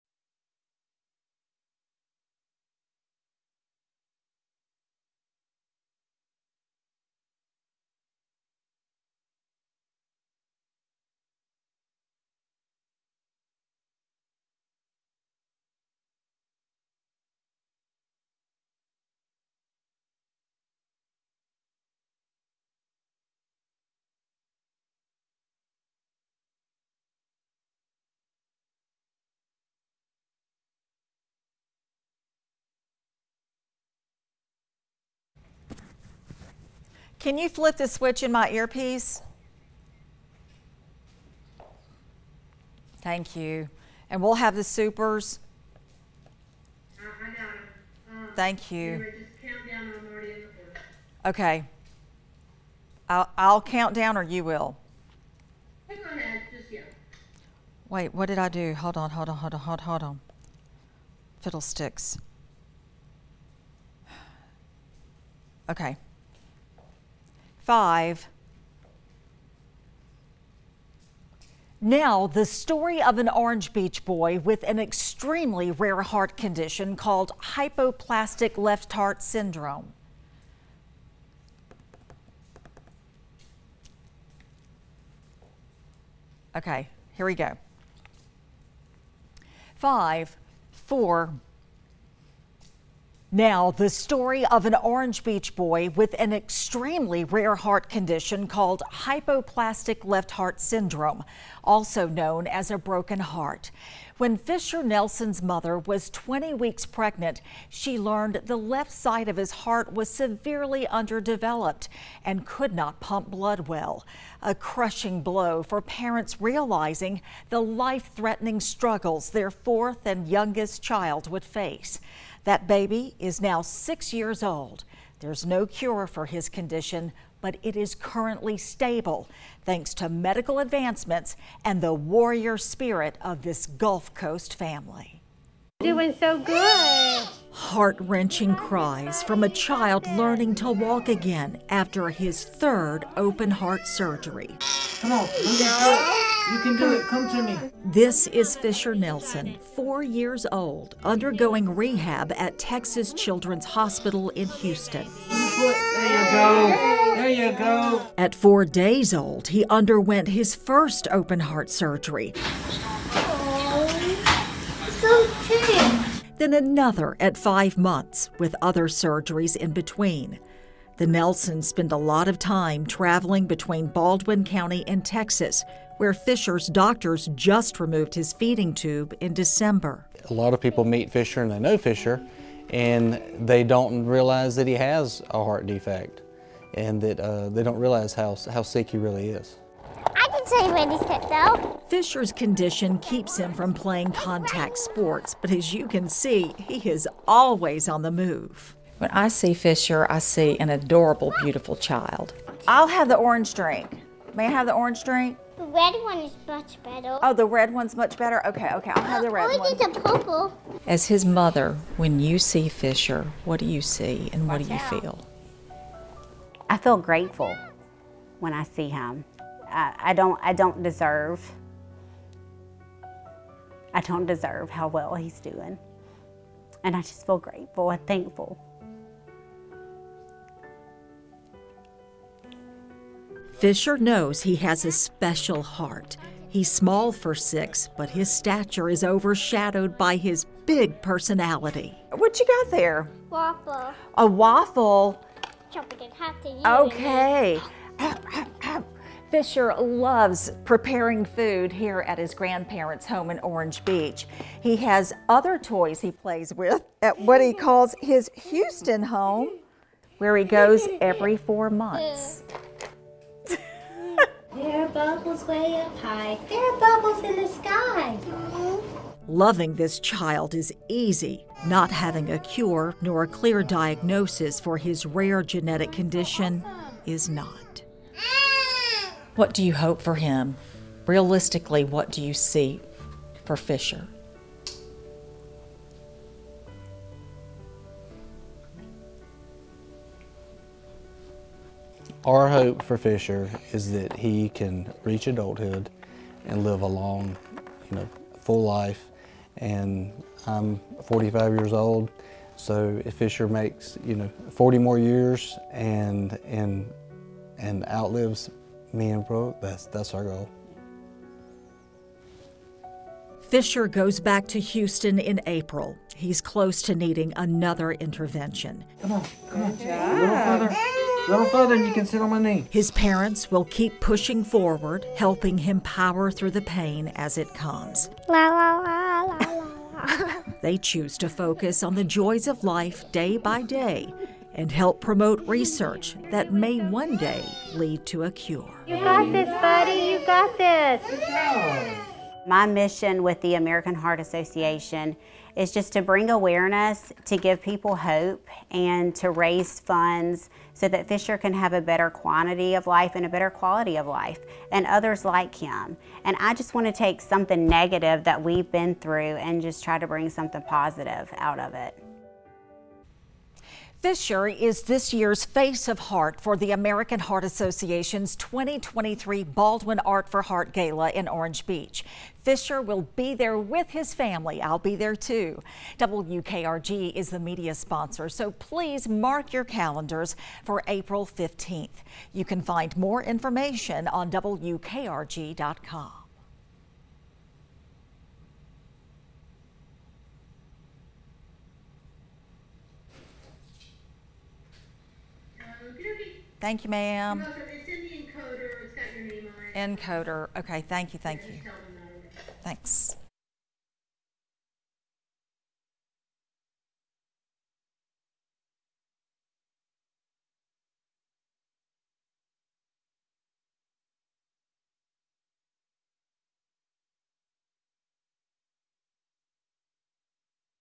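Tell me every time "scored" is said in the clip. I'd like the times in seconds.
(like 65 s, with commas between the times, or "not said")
not said.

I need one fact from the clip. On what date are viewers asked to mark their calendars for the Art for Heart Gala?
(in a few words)
April 15.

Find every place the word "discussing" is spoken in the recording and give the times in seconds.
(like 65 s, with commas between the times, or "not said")
not said.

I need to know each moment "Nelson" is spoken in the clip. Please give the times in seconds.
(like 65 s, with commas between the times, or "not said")
104 s, 148 s, 171 s.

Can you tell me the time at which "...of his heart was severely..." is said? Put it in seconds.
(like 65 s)
109 s.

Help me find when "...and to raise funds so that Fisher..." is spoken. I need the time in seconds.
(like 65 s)
348 s.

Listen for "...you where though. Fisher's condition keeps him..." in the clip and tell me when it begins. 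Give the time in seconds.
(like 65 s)
190 s.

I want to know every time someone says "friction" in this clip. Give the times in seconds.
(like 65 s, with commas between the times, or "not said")
not said.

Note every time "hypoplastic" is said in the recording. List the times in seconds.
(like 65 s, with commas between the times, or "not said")
77 s, 98 s.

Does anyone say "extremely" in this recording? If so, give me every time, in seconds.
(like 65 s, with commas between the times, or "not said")
74 s, 96 s.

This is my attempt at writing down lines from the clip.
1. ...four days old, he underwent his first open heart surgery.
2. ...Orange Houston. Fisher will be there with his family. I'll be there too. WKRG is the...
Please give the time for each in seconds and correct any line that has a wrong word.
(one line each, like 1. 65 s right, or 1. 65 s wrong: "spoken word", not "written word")
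1. 158 s right
2. 371 s wrong: "Beach", not "Houston".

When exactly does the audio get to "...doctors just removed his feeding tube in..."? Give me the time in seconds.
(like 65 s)
176 s.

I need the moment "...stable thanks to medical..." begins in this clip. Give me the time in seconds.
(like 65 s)
128 s.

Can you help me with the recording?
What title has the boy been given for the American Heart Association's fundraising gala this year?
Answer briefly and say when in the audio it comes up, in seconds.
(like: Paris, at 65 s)
Face of Heart, at 365 s.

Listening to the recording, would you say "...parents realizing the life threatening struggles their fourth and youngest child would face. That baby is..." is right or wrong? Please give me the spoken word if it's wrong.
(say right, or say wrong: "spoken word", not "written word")
right.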